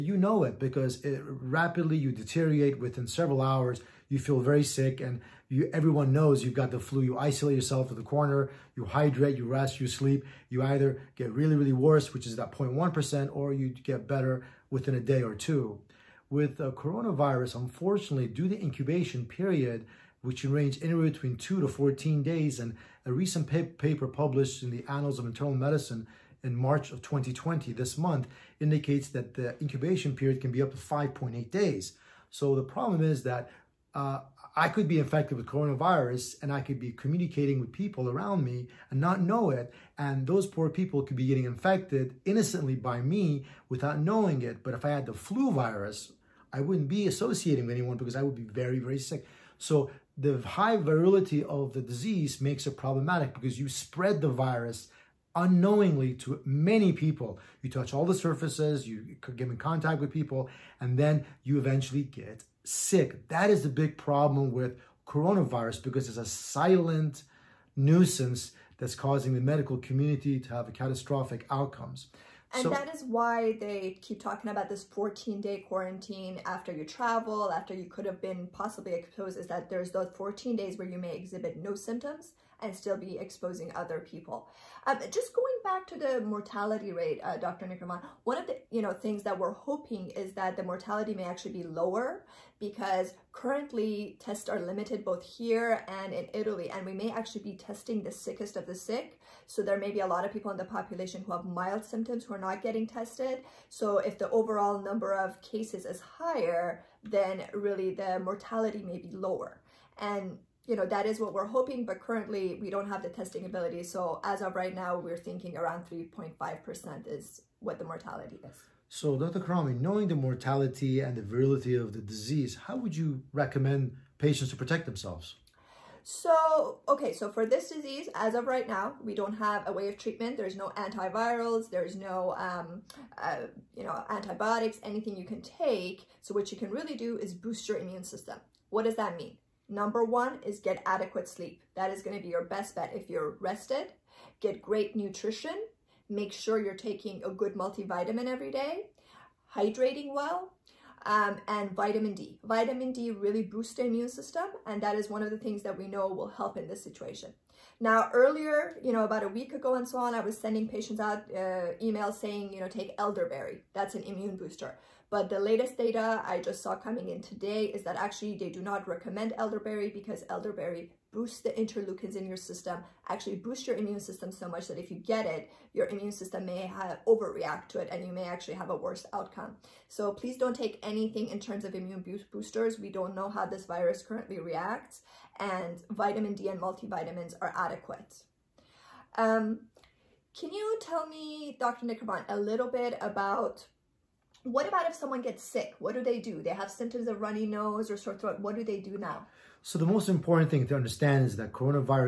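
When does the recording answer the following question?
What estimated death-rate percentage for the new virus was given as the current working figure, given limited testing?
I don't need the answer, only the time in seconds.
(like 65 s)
115 s.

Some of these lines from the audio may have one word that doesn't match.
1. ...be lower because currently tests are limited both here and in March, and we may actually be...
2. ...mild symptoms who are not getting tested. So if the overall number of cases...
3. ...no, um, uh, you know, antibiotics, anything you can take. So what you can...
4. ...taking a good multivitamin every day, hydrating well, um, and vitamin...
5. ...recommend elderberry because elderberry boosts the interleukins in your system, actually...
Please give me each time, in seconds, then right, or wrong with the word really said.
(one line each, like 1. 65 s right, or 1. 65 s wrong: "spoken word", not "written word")
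1. 91 s wrong: "Italy", not "March"
2. 101 s right
3. 131 s right
4. 146 s right
5. 168 s right.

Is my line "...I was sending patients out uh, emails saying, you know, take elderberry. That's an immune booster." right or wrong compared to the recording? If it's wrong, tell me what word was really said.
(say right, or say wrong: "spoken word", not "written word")
right.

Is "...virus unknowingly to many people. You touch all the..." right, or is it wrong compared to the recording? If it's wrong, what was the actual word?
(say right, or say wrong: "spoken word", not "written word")
right.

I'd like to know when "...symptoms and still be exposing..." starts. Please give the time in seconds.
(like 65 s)
81 s.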